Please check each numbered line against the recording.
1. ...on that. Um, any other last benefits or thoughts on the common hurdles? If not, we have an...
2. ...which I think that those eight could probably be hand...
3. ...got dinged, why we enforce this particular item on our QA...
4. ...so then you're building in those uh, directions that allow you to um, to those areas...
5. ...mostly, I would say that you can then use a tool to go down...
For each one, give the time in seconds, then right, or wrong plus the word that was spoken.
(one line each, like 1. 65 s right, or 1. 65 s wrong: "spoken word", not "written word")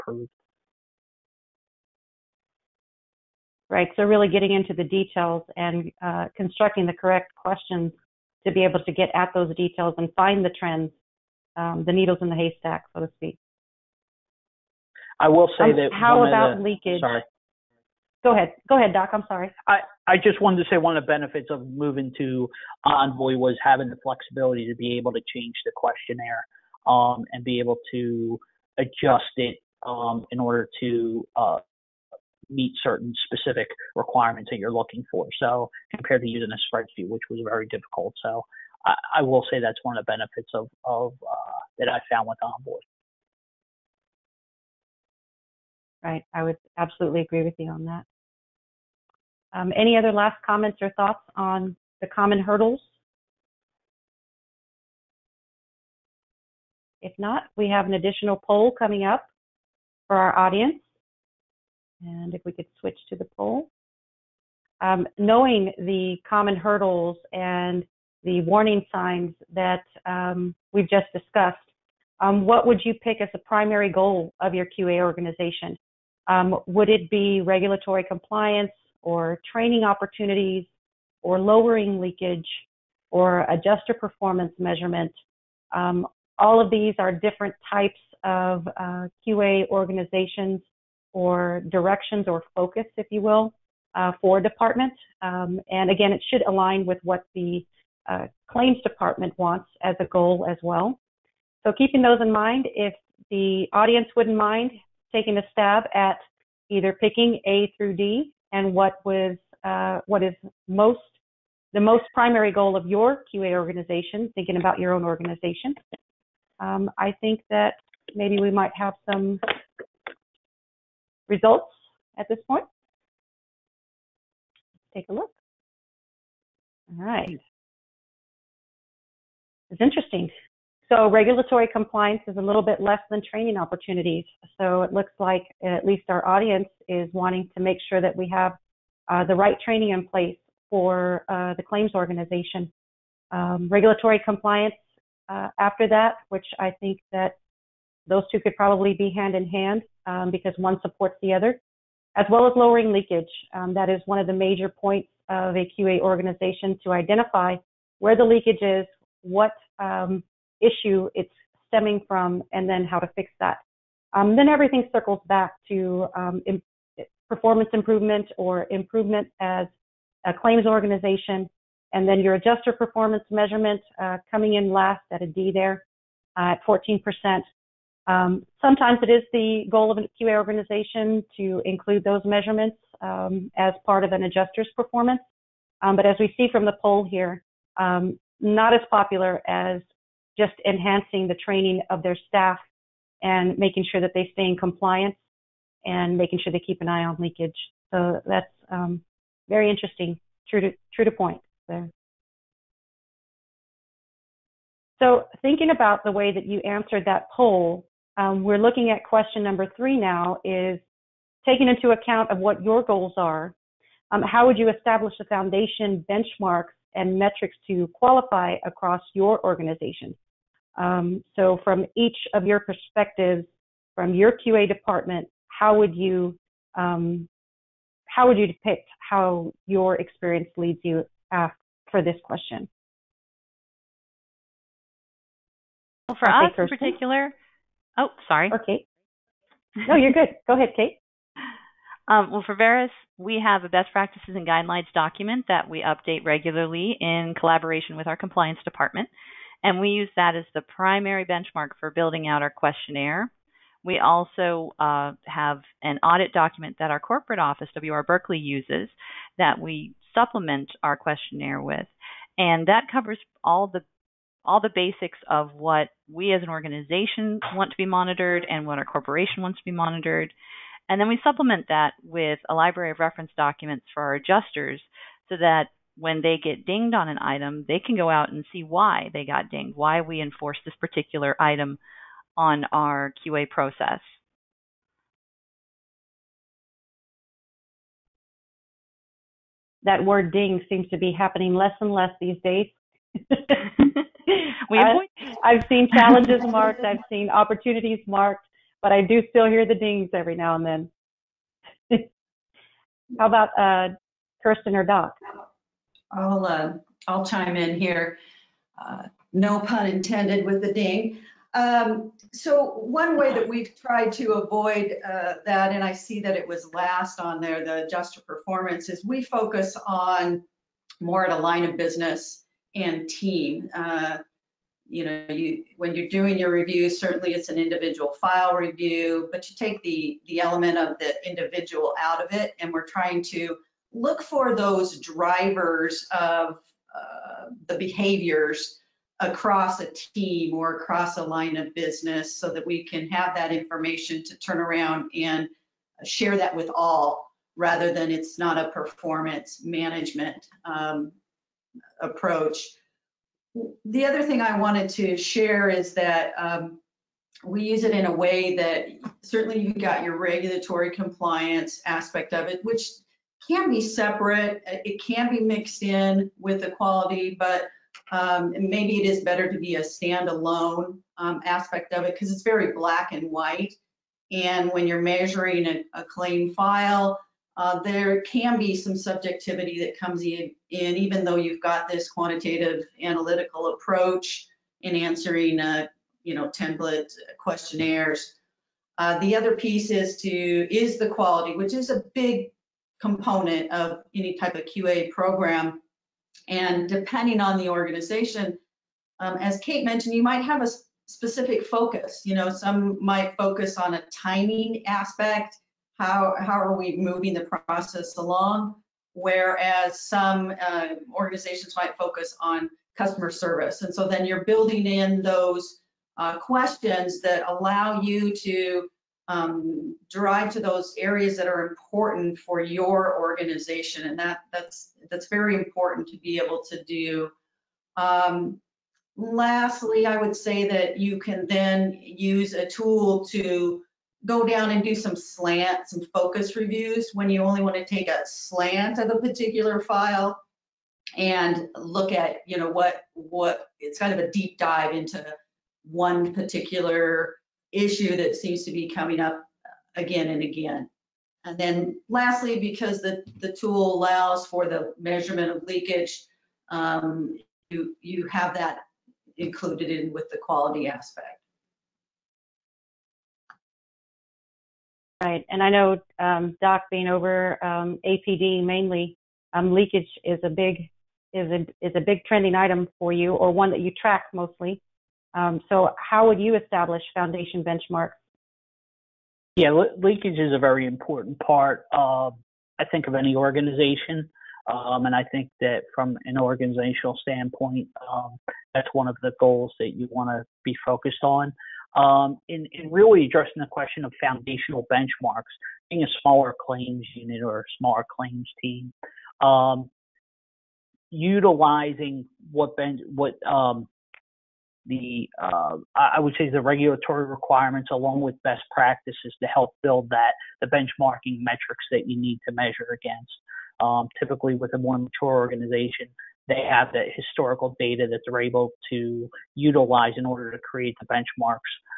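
1. 47 s wrong: "comments", not "benefits"
2. 146 s wrong: "two", not "eight"
3. 279 s right
4. 413 s wrong: "questions", not "directions"
5. 429 s wrong: "lastly", not "mostly".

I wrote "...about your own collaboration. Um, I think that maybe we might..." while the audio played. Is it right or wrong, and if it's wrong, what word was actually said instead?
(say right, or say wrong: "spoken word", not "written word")
wrong: "organization", not "collaboration".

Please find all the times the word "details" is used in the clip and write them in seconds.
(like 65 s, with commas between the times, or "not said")
4 s, 9 s.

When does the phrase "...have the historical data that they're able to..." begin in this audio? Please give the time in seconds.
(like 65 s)
516 s.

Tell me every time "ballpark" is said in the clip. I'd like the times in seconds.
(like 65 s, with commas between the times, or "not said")
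not said.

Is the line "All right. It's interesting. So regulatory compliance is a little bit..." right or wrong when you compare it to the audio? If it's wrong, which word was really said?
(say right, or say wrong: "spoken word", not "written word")
right.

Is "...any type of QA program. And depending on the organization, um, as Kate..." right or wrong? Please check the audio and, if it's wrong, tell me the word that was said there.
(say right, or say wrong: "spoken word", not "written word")
right.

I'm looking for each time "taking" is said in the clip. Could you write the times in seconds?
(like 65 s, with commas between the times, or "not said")
105 s, 211 s.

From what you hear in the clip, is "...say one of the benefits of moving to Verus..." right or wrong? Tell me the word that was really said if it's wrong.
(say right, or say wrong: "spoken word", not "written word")
wrong: "Envoy", not "Verus".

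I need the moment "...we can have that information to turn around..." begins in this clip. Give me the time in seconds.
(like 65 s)
342 s.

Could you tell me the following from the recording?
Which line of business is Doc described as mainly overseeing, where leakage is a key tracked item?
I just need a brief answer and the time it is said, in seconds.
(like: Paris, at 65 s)
APD, at 468 s.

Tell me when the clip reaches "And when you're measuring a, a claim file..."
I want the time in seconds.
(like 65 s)
374 s.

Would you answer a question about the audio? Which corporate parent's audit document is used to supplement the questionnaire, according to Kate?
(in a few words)
WR Berkley.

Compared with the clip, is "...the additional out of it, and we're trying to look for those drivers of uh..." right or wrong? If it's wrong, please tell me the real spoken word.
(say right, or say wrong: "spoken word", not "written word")
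wrong: "individual", not "additional".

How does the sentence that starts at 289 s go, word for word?
That word ding seems to be happening less and less these days.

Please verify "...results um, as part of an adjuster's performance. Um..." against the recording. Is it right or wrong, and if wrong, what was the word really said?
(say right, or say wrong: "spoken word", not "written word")
wrong: "measurements", not "results".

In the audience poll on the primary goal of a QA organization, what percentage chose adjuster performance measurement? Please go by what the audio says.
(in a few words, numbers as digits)
14%.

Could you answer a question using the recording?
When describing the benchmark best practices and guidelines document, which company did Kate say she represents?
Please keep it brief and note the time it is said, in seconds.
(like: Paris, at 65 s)
Verus, at 242 s.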